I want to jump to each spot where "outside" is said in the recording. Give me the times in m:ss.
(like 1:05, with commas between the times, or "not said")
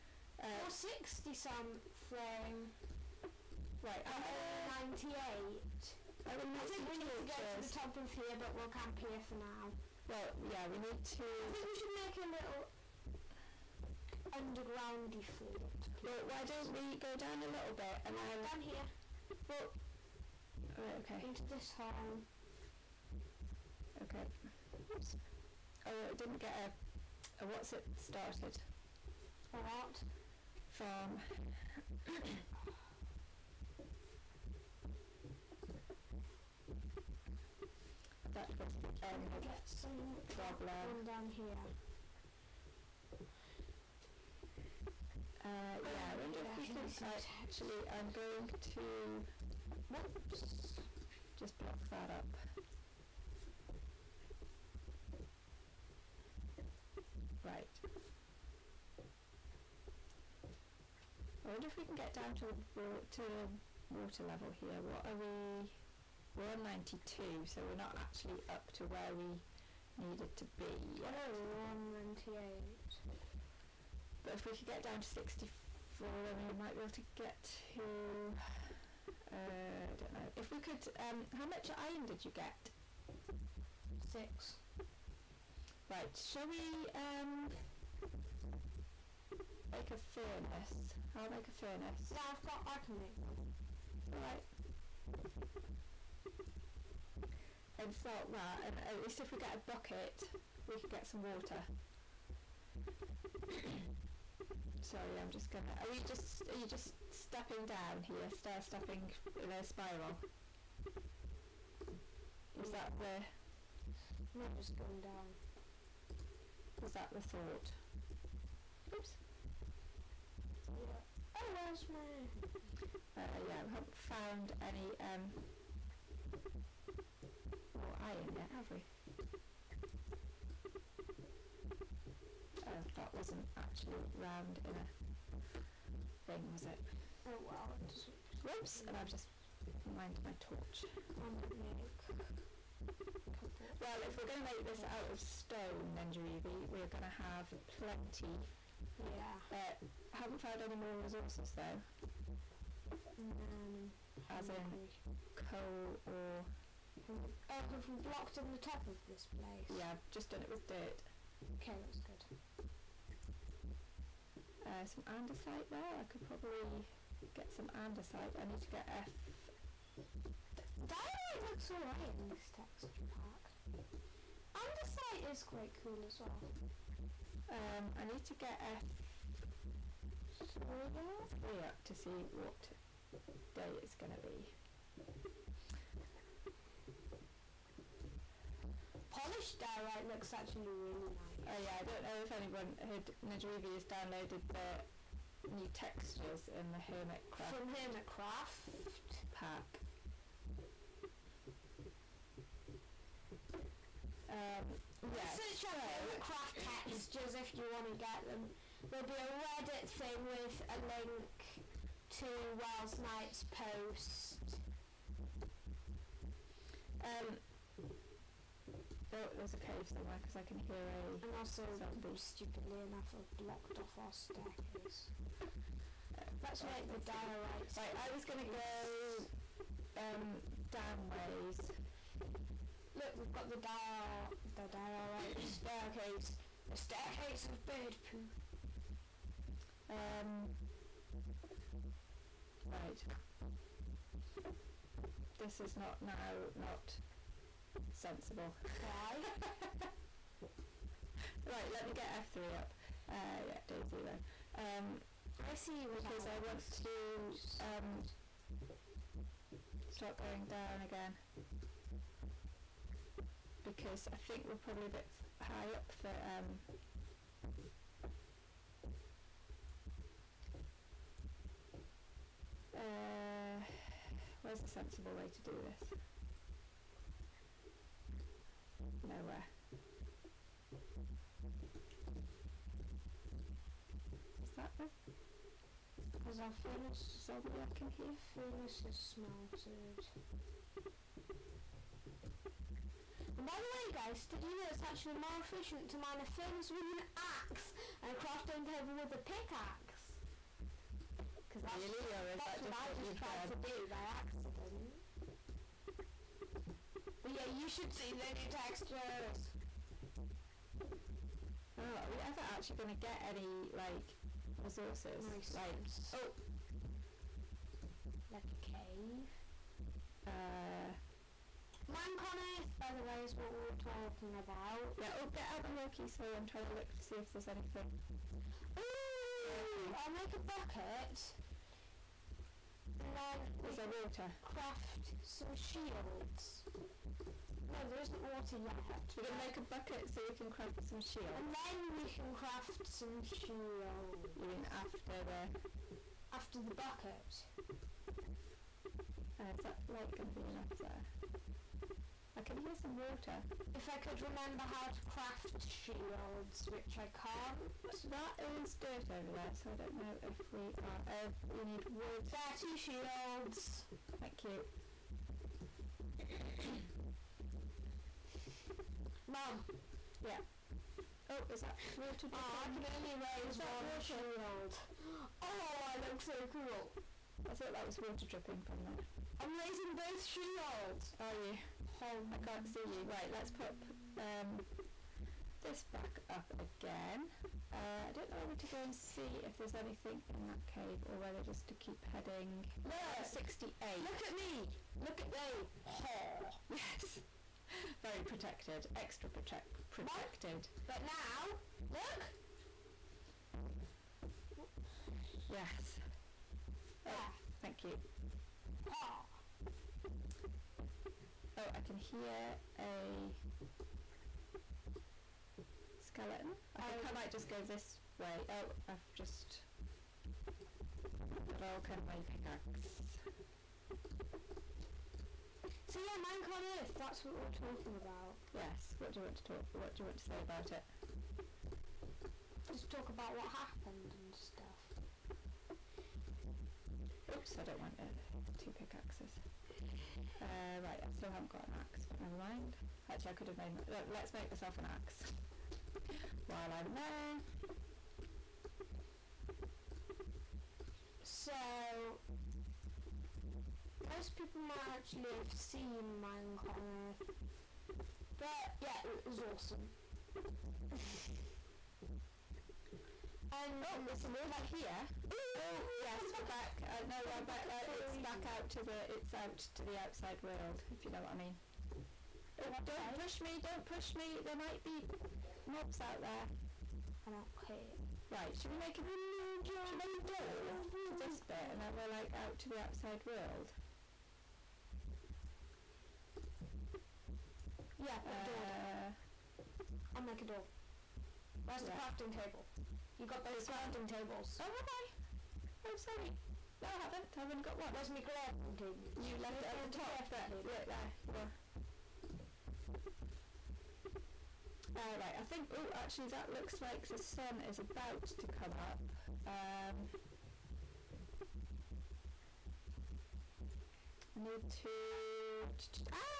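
7:49, 8:02.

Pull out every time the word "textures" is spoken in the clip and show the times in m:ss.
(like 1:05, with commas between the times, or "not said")
2:52, 3:15, 3:26, 5:08.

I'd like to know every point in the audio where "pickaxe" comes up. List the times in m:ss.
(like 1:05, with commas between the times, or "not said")
4:59, 7:02, 7:18.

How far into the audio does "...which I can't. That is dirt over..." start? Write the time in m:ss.
5:56.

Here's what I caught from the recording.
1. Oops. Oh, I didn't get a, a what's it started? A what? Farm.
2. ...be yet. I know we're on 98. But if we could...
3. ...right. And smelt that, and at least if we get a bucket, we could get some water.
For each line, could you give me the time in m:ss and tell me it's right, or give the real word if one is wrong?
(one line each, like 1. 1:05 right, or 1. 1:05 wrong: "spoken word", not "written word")
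1. 0:24 right
2. 1:10 right
3. 1:34 right.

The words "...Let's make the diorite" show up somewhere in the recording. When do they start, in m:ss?
3:46.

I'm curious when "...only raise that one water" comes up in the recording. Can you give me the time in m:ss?
6:12.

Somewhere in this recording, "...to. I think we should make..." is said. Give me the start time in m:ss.
0:11.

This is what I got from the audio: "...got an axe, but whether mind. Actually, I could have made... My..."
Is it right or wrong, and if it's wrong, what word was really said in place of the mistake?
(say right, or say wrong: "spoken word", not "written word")
wrong: "never", not "whether".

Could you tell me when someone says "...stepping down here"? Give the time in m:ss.
1:47.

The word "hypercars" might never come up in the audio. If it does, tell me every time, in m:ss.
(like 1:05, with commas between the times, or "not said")
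not said.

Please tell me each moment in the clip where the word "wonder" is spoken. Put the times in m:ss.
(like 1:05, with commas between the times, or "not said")
0:46, 1:01.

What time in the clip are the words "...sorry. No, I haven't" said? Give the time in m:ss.
8:16.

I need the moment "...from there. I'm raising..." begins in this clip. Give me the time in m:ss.
6:18.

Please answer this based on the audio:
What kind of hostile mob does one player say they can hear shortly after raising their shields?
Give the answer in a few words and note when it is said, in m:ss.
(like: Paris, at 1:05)
Skeleton, at 6:56.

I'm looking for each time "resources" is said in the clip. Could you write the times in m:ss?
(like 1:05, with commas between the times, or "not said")
2:30, 5:14.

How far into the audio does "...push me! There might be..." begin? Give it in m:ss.
7:53.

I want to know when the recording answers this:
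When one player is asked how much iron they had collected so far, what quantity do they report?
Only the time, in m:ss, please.
1:24.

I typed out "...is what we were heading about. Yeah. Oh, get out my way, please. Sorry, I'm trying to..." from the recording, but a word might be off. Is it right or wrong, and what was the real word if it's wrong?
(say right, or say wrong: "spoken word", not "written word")
wrong: "talking", not "heading".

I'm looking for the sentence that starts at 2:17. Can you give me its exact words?
Oh, well, it Whoops, and I've just mined my torch.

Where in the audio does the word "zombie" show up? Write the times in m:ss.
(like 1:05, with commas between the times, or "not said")
3:41, 4:47.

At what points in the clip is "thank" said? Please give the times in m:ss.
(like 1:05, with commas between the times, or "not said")
6:04, 6:47.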